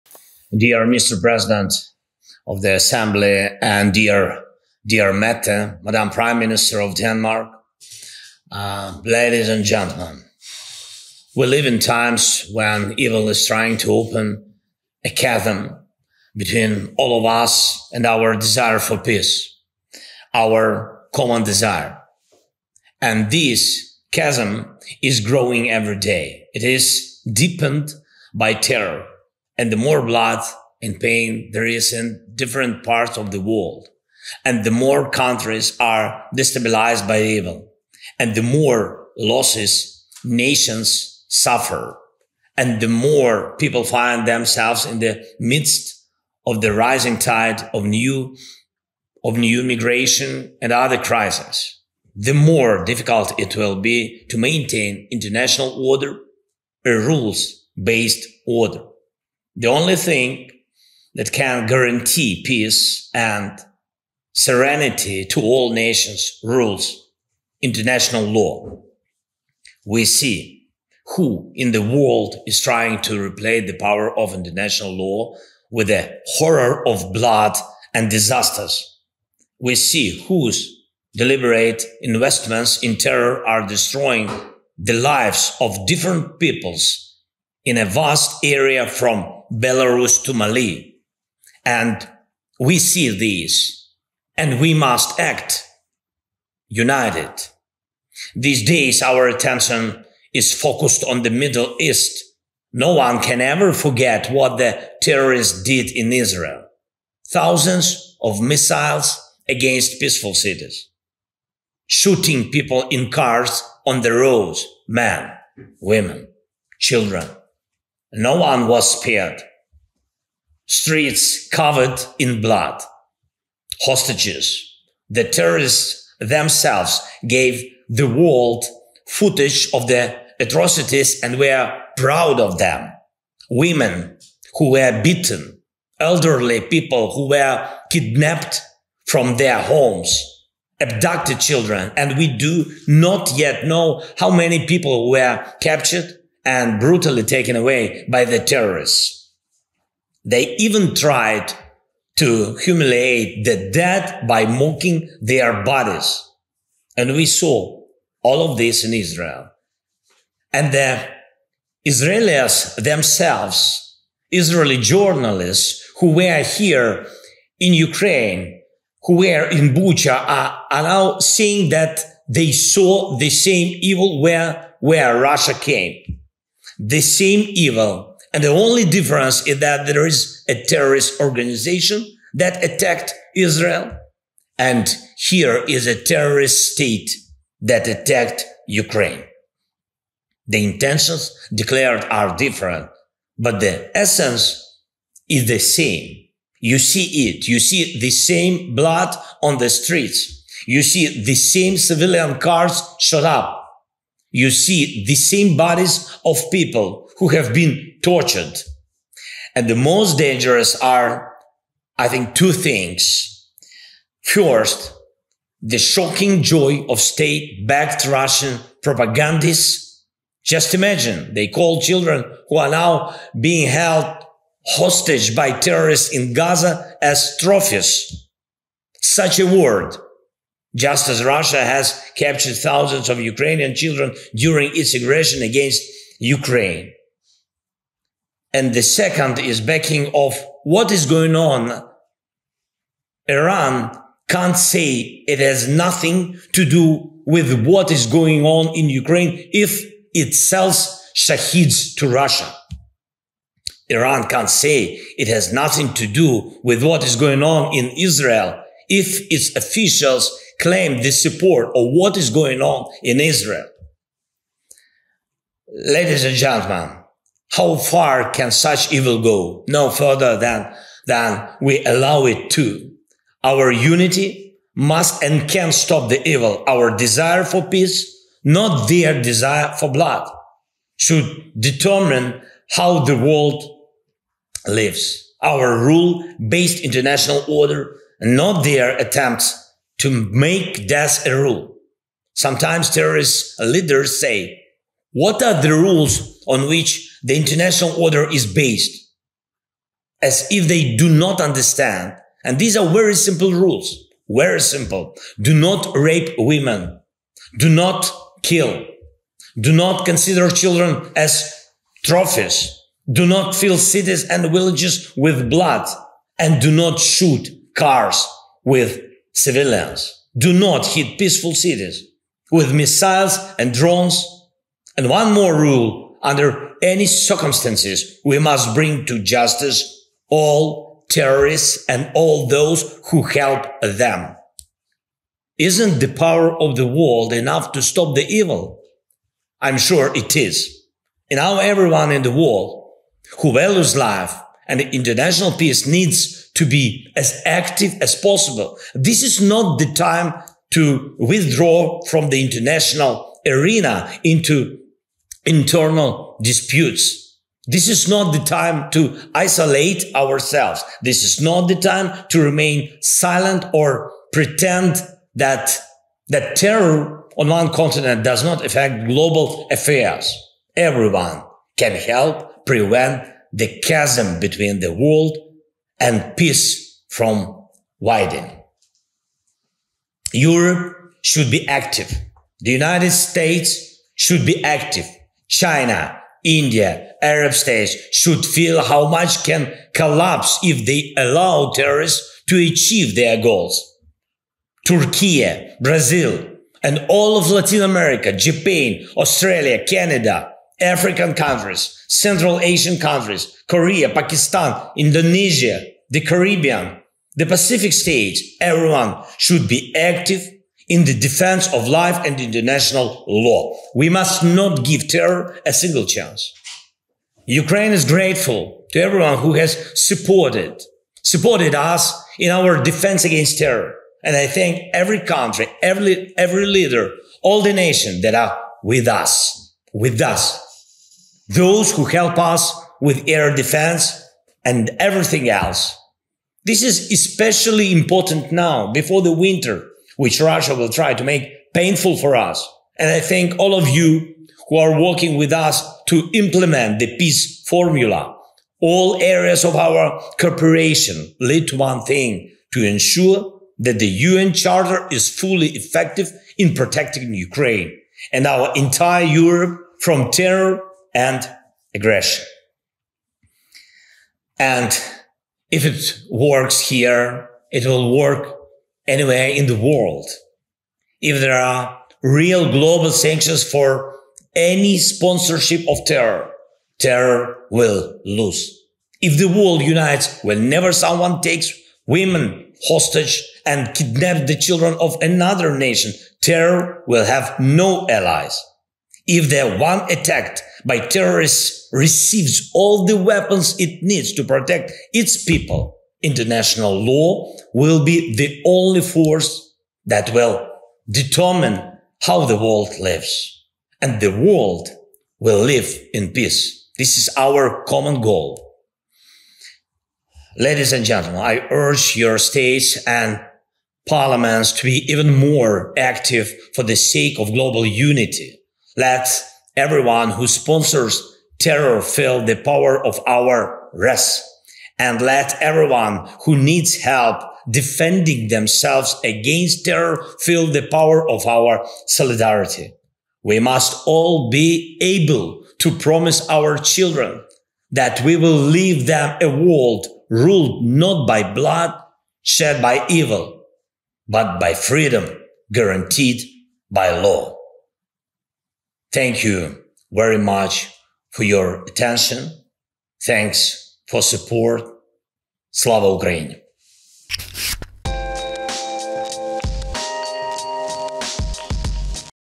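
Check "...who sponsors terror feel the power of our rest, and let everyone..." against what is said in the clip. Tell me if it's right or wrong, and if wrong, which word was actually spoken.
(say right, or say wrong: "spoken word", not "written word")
right.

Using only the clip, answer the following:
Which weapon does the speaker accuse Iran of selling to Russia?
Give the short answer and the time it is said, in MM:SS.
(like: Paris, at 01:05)
Shaheds, at 04:11.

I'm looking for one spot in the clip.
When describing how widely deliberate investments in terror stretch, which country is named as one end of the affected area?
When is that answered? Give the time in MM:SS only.
01:30.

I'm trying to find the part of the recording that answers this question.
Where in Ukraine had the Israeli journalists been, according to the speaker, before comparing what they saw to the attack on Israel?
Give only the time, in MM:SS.
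02:49.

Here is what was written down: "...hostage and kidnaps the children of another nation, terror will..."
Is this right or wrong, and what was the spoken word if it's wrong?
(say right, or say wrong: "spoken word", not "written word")
right.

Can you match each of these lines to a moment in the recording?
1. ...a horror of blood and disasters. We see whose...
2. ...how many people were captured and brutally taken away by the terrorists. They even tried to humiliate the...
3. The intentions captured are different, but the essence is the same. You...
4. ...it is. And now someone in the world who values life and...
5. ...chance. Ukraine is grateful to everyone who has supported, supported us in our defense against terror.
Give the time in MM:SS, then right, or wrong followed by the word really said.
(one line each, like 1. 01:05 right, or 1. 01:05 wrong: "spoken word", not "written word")
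1. 01:15 right
2. 02:24 right
3. 03:10 wrong: "declared", not "captured"
4. 05:40 wrong: "everyone", not "someone"
5. 06:56 right.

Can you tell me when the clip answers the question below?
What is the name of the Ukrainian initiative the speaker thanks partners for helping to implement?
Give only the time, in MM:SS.
07:27.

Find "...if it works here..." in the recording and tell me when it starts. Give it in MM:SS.
07:45.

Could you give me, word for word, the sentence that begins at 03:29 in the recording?
And the most dangerous are, I think, two things.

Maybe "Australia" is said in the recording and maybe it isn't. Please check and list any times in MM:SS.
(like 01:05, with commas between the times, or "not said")
06:39.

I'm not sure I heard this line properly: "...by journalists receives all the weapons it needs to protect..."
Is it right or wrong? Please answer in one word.
wrong.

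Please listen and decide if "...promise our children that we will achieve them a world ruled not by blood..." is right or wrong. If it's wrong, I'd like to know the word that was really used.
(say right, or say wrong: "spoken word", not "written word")
wrong: "leave", not "achieve".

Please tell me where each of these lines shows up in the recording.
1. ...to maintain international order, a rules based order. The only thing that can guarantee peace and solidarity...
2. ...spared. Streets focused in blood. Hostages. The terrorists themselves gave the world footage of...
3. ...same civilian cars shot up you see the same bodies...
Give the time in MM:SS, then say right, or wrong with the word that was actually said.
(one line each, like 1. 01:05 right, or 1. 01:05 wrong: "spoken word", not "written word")
1. 00:54 wrong: "serenity", not "solidarity"
2. 01:58 wrong: "covered", not "focused"
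3. 03:21 right.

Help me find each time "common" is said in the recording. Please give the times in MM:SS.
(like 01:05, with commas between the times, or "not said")
00:21, 08:27.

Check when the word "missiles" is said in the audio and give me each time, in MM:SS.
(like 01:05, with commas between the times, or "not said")
01:48, 05:22.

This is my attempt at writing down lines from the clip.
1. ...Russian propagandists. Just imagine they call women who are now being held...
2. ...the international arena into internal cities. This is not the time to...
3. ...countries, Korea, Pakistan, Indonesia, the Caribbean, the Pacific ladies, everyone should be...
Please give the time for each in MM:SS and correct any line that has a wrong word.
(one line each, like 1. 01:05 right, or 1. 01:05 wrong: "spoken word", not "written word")
1. 03:38 wrong: "children", not "women"
2. 05:52 wrong: "disputes", not "cities"
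3. 06:42 wrong: "states", not "ladies".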